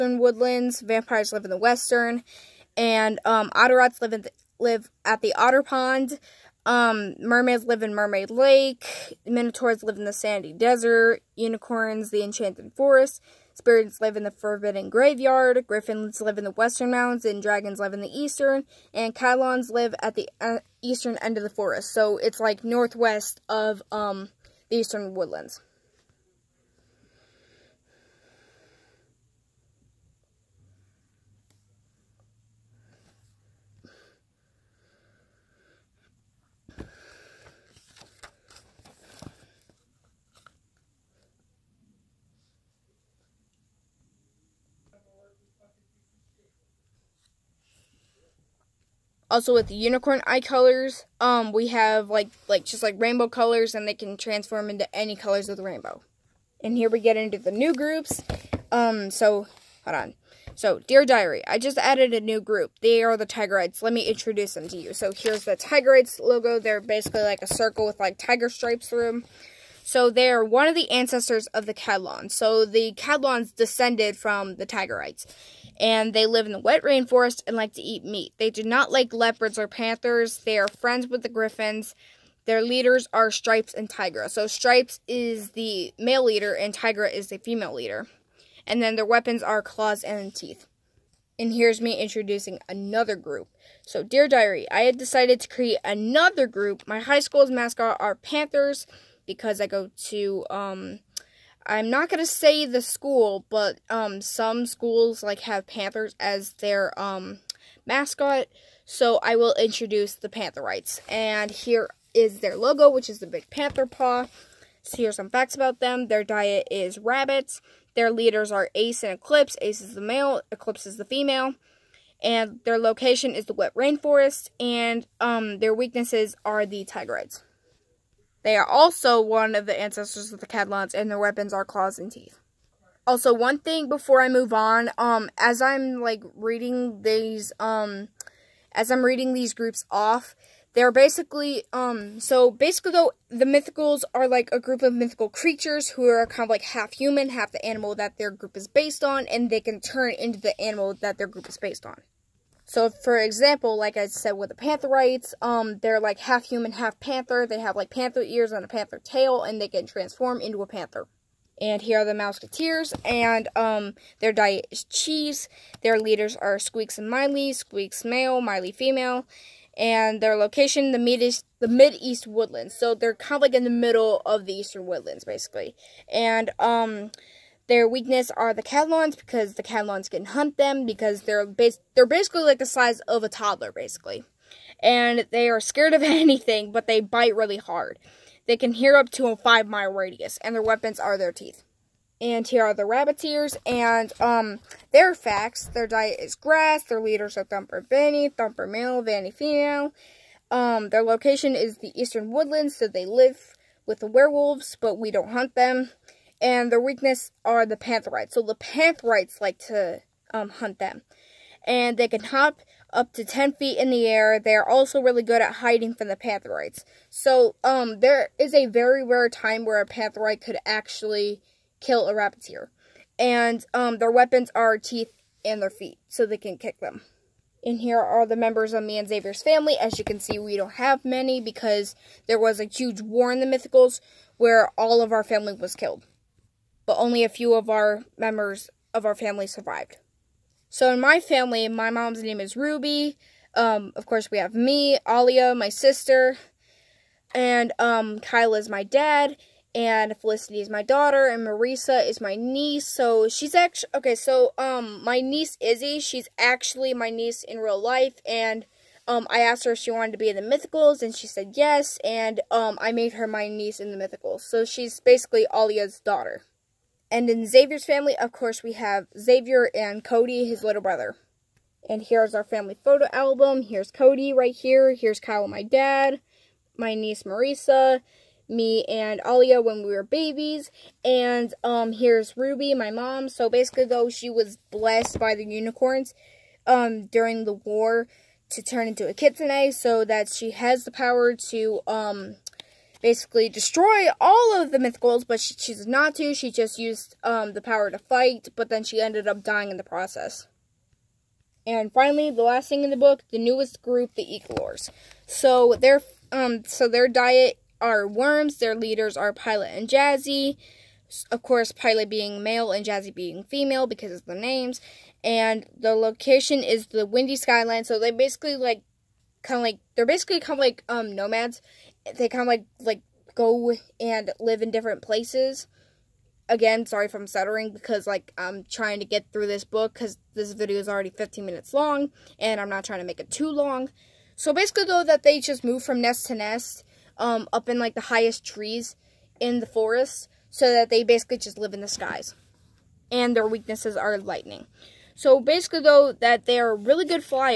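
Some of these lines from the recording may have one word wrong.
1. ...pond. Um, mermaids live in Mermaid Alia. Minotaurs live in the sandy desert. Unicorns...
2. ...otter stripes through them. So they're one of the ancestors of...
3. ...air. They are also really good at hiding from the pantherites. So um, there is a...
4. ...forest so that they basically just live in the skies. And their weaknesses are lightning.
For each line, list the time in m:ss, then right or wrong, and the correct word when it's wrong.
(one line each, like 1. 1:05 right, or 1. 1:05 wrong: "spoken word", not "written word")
1. 0:05 wrong: "Lake", not "Alia"
2. 1:08 wrong: "tiger", not "otter"
3. 3:34 right
4. 5:39 right.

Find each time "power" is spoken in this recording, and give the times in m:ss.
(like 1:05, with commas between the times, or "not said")
4:50, 4:57.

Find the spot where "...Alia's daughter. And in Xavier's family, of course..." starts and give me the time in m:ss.
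4:25.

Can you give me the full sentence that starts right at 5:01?
And finally, the last thing in the book, the newest group, the Eaglores.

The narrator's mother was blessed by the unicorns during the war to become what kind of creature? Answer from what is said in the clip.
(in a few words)
Kitsune.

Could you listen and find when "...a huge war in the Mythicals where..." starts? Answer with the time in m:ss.
3:52.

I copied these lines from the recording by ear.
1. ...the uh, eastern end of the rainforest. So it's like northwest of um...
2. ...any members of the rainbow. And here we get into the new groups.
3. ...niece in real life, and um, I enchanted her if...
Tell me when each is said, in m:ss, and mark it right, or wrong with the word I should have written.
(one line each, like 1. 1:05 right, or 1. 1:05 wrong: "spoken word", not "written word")
1. 0:20 wrong: "forest", not "rainforest"
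2. 0:54 wrong: "colors", not "members"
3. 4:17 wrong: "asked", not "enchanted".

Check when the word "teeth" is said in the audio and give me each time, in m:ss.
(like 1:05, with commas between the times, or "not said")
1:30, 2:12, 3:11, 3:44.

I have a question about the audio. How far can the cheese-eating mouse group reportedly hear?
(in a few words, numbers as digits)
5 mile radius.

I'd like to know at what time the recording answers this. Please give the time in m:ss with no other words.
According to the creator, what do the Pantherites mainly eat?
1:56.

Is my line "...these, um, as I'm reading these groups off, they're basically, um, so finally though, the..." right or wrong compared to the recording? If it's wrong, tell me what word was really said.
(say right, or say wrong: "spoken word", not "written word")
wrong: "basically", not "finally".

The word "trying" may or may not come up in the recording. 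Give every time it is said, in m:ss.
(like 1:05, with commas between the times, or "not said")
5:28, 5:32.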